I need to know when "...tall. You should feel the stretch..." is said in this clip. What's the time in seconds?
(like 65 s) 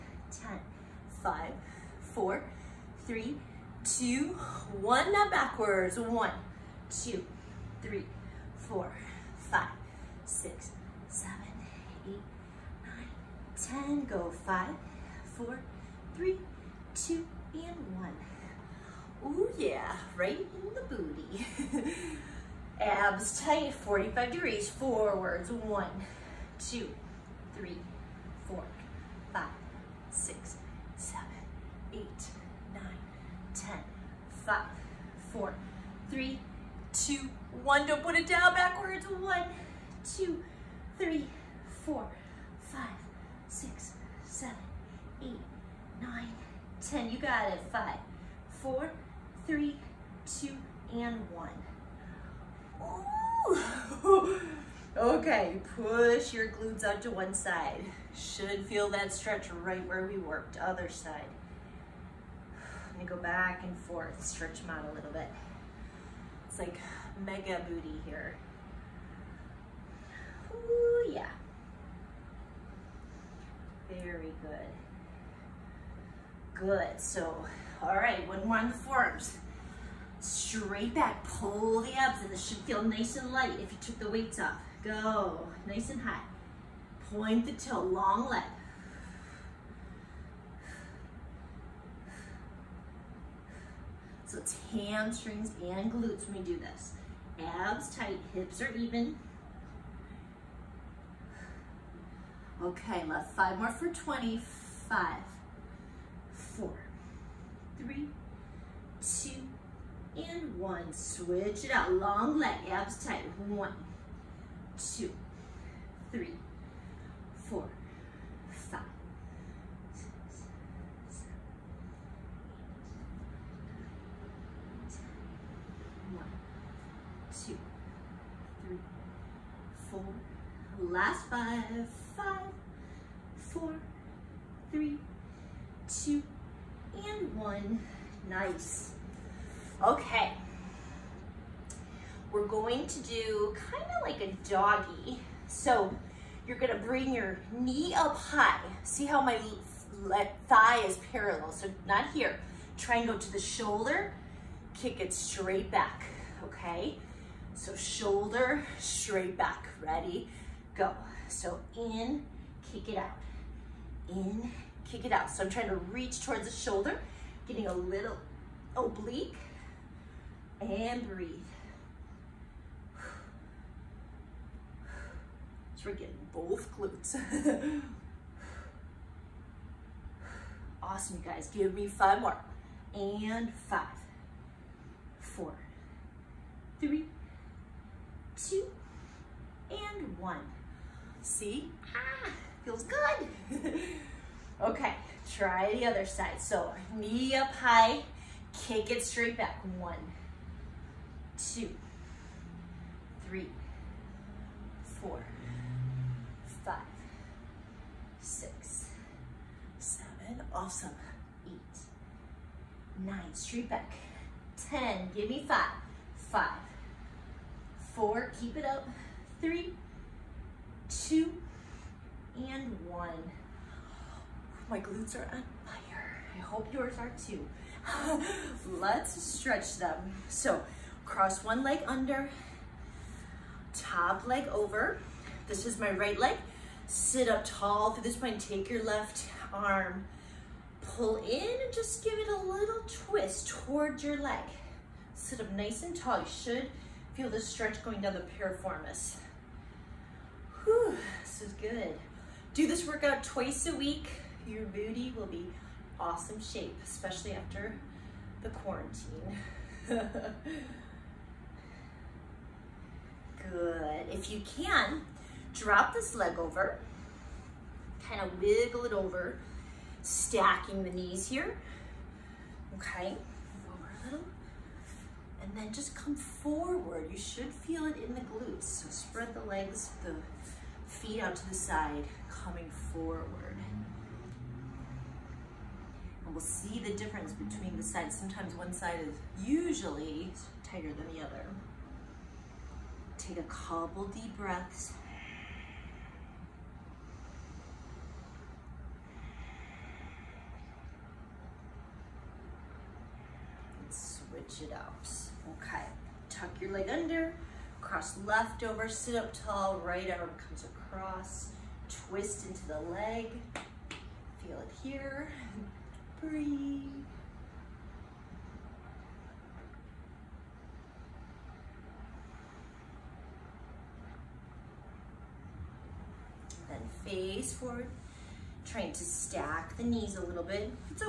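245 s.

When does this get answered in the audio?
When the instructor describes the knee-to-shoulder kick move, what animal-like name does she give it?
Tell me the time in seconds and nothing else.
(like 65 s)
144 s.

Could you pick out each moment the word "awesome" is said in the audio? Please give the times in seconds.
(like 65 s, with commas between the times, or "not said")
180 s, 210 s, 255 s.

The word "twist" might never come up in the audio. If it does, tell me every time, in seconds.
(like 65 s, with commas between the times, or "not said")
242 s, 312 s.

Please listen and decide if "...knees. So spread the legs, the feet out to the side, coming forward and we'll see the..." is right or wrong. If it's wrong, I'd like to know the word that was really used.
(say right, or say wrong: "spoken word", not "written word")
wrong: "glutes", not "knees".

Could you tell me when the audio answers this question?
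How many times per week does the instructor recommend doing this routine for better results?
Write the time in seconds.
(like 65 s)
253 s.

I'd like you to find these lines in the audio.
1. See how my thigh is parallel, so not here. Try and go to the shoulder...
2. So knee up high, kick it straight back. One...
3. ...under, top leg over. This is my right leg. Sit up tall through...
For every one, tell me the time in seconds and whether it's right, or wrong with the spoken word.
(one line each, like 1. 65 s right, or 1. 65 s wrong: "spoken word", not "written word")
1. 148 s right
2. 196 s right
3. 231 s right.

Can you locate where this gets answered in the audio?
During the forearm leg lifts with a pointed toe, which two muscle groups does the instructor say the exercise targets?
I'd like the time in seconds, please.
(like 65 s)
94 s.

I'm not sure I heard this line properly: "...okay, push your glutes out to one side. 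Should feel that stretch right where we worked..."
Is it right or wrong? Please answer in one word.
right.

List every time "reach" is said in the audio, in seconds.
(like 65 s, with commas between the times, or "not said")
165 s.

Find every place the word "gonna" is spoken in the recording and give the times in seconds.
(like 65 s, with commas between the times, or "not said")
63 s, 146 s.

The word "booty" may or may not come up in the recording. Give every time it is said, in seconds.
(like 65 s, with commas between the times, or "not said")
20 s, 67 s, 254 s.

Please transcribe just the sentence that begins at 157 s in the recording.
So shoulder, straight back, ready, go.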